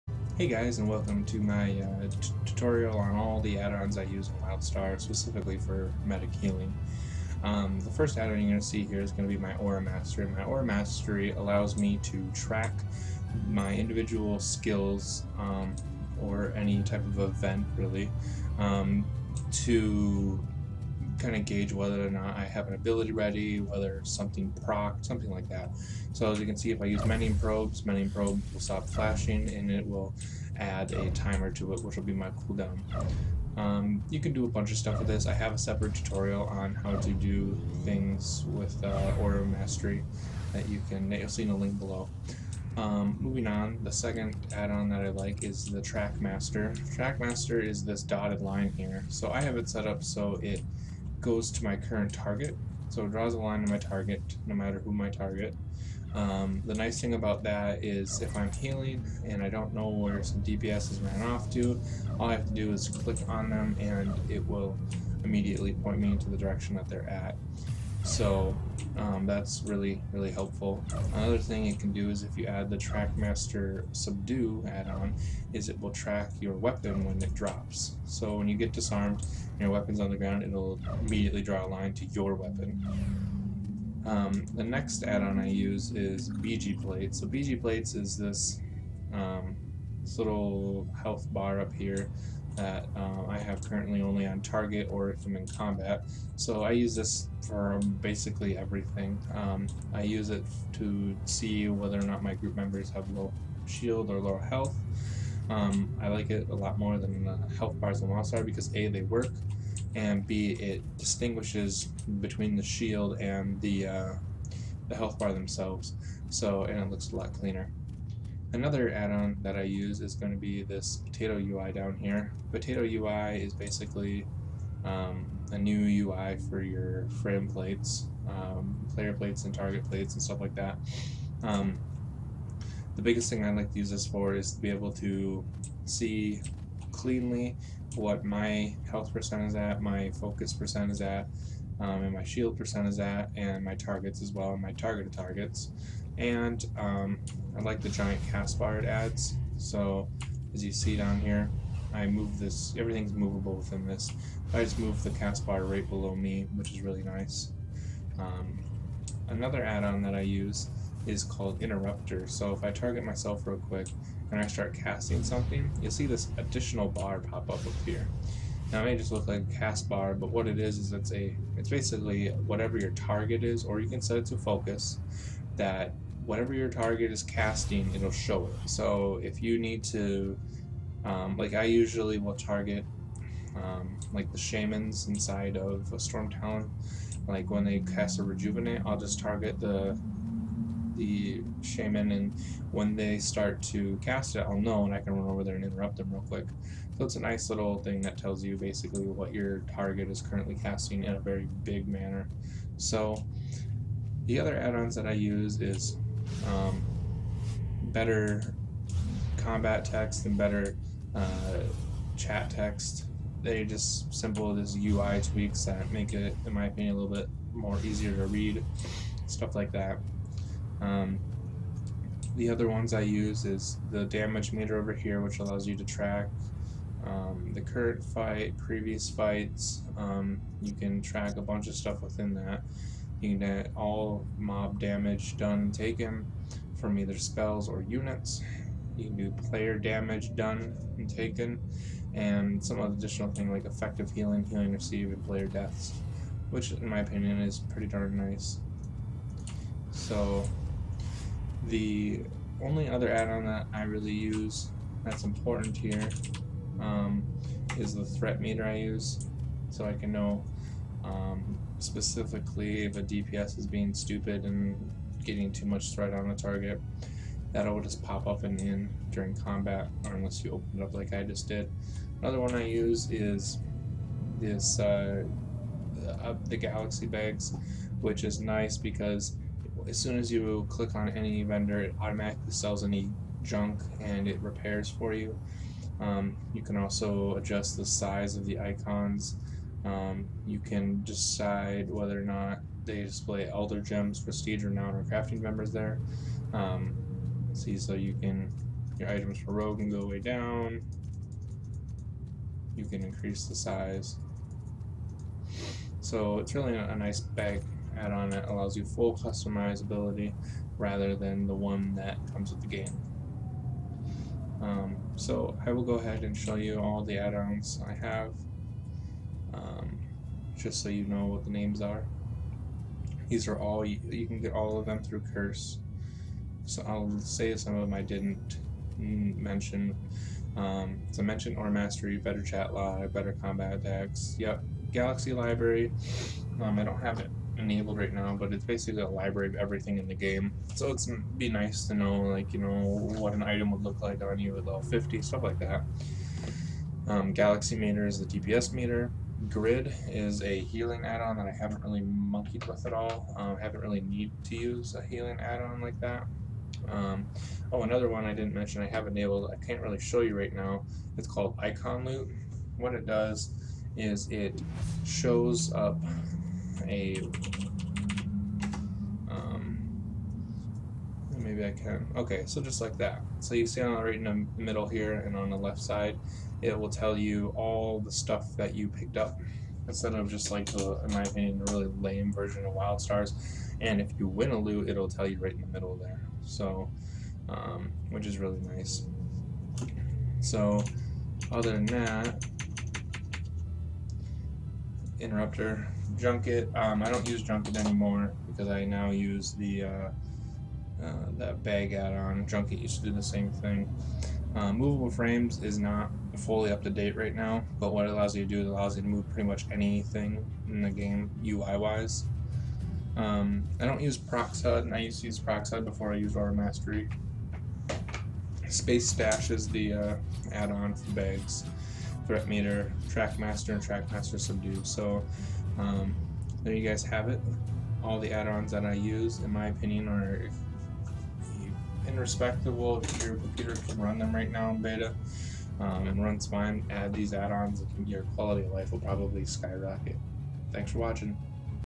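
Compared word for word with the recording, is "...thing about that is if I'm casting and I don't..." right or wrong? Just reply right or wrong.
wrong.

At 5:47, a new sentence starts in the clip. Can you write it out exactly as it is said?
Um, Galaxy meter is the DPS meter.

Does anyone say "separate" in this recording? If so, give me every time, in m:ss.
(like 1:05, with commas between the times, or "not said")
0:35.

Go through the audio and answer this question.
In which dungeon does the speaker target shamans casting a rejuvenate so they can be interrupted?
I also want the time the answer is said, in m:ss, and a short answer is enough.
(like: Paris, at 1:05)
Stormtalon, at 3:05.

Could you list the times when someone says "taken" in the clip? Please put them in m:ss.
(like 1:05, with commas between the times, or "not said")
3:55, 4:01.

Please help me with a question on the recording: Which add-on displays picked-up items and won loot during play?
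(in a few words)
Icon Loot.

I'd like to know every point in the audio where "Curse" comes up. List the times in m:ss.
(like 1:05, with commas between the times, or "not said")
5:25.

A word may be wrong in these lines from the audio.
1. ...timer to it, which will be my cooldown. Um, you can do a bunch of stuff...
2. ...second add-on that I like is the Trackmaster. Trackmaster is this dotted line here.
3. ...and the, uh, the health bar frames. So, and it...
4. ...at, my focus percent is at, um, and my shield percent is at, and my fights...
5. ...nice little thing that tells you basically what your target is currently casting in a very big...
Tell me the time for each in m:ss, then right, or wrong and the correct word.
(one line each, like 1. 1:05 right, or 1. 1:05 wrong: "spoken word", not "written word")
1. 0:31 right
2. 0:43 right
3. 1:53 wrong: "themselves", not "frames"
4. 2:19 wrong: "targets", not "fights"
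5. 3:17 right.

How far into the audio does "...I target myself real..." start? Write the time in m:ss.
2:42.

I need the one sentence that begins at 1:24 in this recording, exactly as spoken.
Um, the next add-on I use is BijiPlates.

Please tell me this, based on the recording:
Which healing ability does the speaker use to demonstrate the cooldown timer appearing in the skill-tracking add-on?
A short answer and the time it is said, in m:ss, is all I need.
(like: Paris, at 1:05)
Mending Probes, at 0:27.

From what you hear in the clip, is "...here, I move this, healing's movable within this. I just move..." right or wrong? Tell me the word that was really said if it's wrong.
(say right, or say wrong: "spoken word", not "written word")
wrong: "everything", not "healing".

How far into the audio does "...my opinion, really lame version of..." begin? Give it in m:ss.
6:21.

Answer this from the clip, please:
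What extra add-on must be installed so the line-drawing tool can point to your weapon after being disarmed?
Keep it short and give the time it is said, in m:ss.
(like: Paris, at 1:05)
Trackmaster Subdue, at 1:12.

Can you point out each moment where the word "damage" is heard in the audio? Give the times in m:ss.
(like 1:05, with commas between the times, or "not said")
3:44, 3:54, 3:59.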